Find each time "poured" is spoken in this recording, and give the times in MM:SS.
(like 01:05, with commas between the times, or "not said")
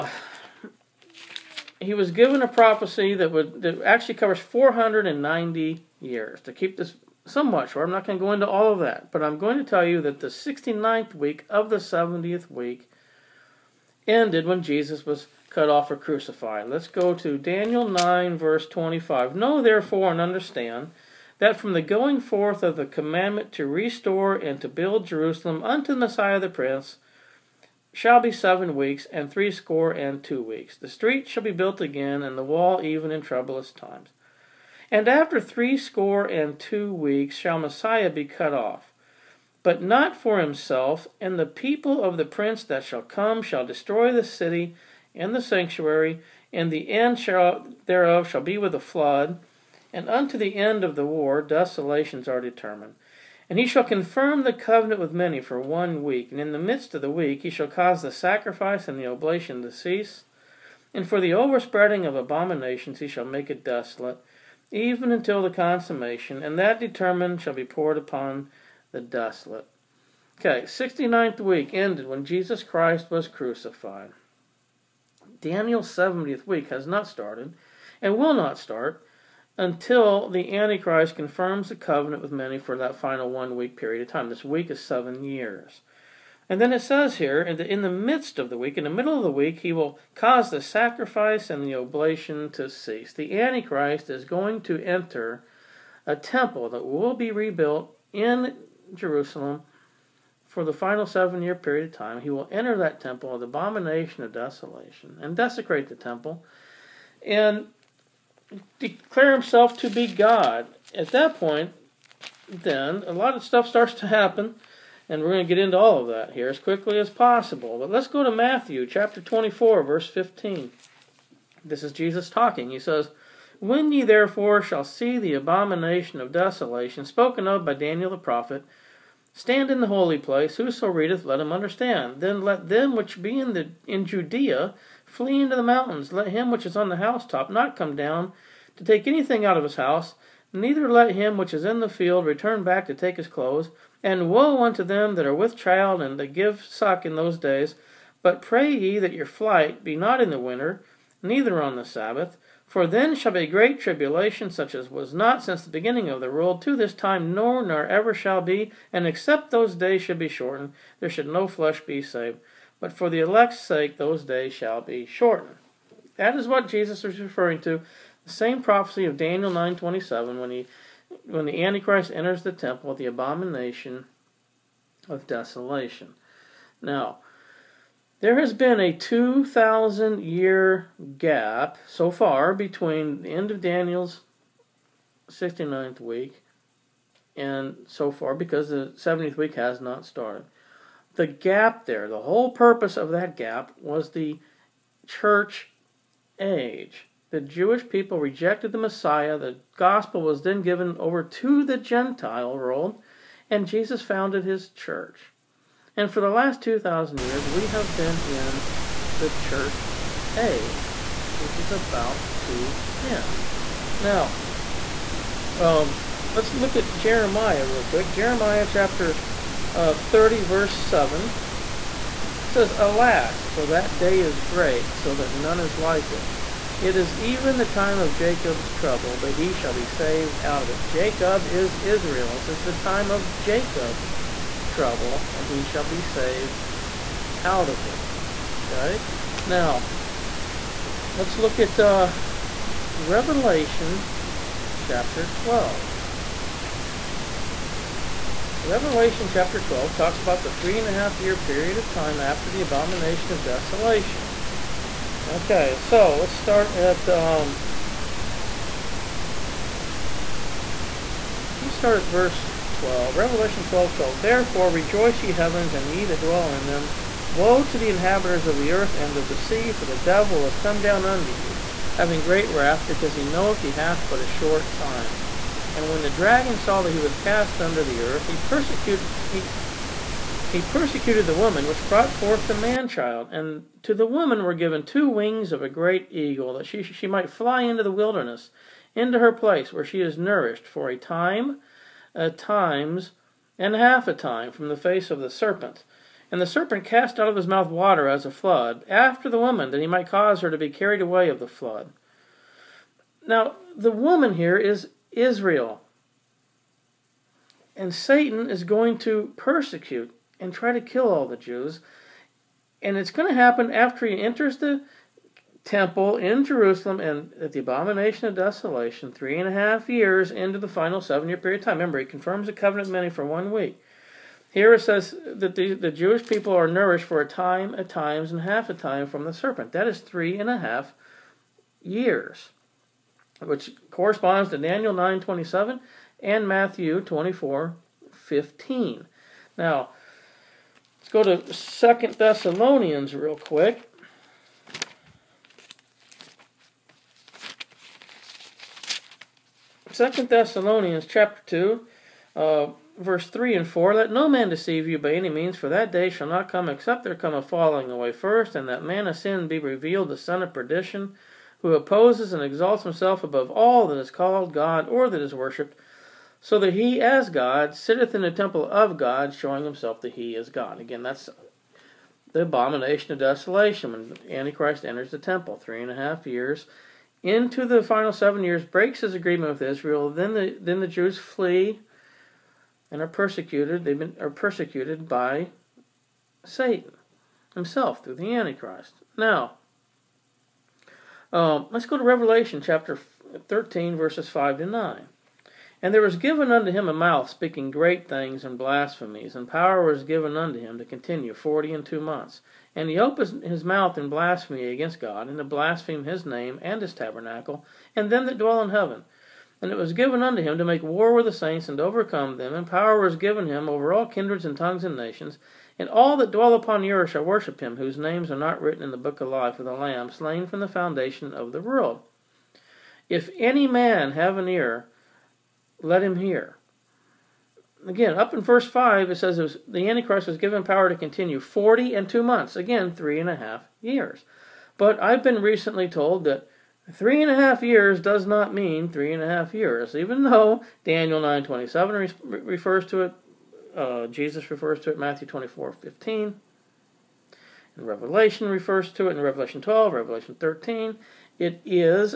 01:07.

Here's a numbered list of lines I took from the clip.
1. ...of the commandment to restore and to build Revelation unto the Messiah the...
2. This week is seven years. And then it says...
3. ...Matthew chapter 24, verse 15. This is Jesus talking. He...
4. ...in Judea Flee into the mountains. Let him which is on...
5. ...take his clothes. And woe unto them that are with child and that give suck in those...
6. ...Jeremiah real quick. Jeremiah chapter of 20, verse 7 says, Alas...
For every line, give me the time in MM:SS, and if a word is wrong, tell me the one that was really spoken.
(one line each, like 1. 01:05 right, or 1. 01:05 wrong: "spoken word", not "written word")
1. 00:22 wrong: "Jerusalem", not "Revelation"
2. 01:24 right
3. 01:58 right
4. 02:13 right
5. 02:22 right
6. 03:36 wrong: "30", not "20".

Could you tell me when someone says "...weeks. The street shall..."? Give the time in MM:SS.
00:30.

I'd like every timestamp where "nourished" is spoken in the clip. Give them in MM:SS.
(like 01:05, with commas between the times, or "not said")
04:50, 05:26.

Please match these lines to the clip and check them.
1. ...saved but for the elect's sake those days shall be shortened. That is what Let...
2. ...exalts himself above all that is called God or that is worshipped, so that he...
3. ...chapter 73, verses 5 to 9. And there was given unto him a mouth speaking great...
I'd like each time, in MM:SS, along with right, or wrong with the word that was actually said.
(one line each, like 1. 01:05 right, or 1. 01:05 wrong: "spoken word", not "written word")
1. 02:42 wrong: "Jesus", not "Let"
2. 06:02 right
3. 06:32 wrong: "13", not "73".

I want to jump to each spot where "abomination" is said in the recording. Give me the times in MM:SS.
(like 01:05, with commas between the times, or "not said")
01:02, 01:43, 02:05, 02:53, 04:12, 05:17, 06:12.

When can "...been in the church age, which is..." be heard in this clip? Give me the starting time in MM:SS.
03:27.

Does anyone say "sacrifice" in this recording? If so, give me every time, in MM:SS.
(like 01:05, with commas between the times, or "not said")
00:58, 01:30.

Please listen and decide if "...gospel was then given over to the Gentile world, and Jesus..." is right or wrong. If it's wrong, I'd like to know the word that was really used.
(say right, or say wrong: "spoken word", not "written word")
right.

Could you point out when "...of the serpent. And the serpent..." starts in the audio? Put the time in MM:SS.
04:55.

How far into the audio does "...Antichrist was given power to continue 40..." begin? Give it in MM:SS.
07:09.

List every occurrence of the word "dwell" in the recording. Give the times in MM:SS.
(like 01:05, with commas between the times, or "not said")
04:26, 06:48, 06:56.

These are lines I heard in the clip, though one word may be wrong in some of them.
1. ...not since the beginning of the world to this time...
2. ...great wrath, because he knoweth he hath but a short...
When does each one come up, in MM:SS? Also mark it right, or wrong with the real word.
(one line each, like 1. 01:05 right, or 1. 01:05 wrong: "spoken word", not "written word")
1. 02:35 right
2. 04:32 right.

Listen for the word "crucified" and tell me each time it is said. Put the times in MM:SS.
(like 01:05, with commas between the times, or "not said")
00:15, 01:13.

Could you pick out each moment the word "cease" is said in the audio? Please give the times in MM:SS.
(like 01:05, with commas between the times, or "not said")
00:59, 01:32.